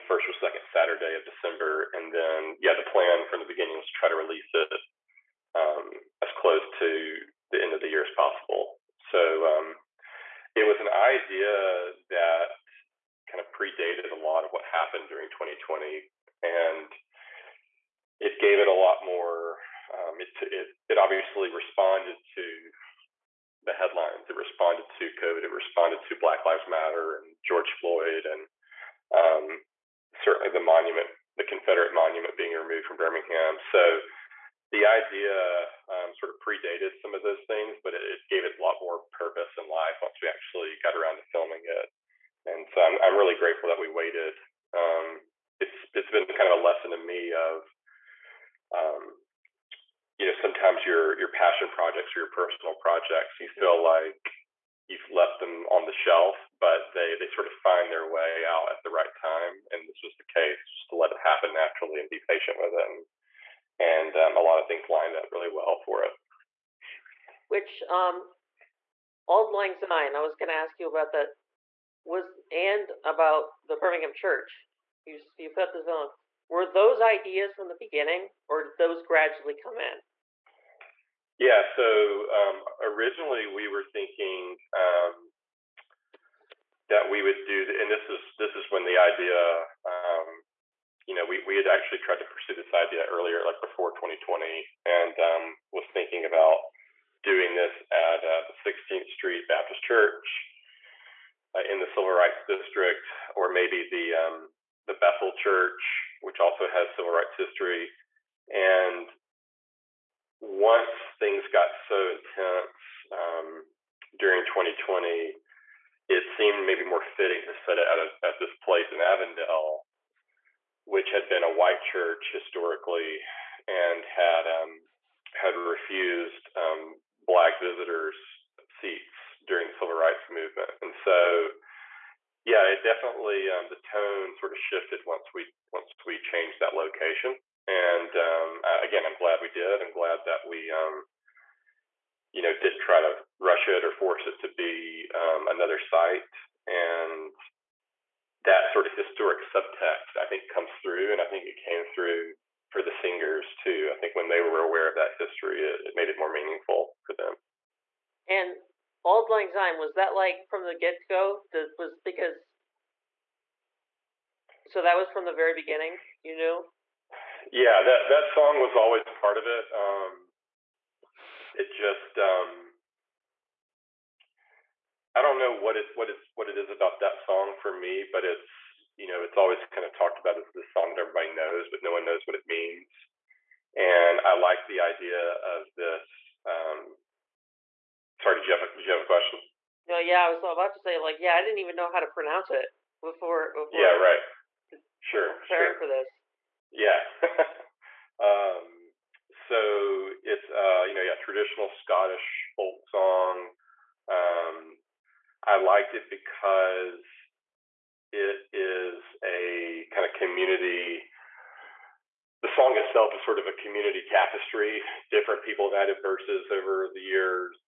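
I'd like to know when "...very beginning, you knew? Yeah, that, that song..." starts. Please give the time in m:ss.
2:45.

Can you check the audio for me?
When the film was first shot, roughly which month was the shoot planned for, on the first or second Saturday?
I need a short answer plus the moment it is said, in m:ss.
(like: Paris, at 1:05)
December, at 0:01.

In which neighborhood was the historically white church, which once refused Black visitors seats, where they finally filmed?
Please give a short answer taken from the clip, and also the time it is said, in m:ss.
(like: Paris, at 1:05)
Avondale, at 1:58.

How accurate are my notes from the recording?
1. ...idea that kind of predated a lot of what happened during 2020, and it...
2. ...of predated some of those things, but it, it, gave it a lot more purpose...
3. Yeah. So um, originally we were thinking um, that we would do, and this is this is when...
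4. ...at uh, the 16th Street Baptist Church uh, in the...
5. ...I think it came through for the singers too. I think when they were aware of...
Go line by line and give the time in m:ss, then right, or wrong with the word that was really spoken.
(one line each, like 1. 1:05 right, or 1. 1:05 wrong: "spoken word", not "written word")
1. 0:10 right
2. 0:36 right
3. 1:21 right
4. 1:37 right
5. 2:31 right.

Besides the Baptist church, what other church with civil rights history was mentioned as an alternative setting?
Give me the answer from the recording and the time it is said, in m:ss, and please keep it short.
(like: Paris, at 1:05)
Bethel Church, at 1:44.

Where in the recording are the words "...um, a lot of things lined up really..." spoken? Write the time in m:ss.
1:04.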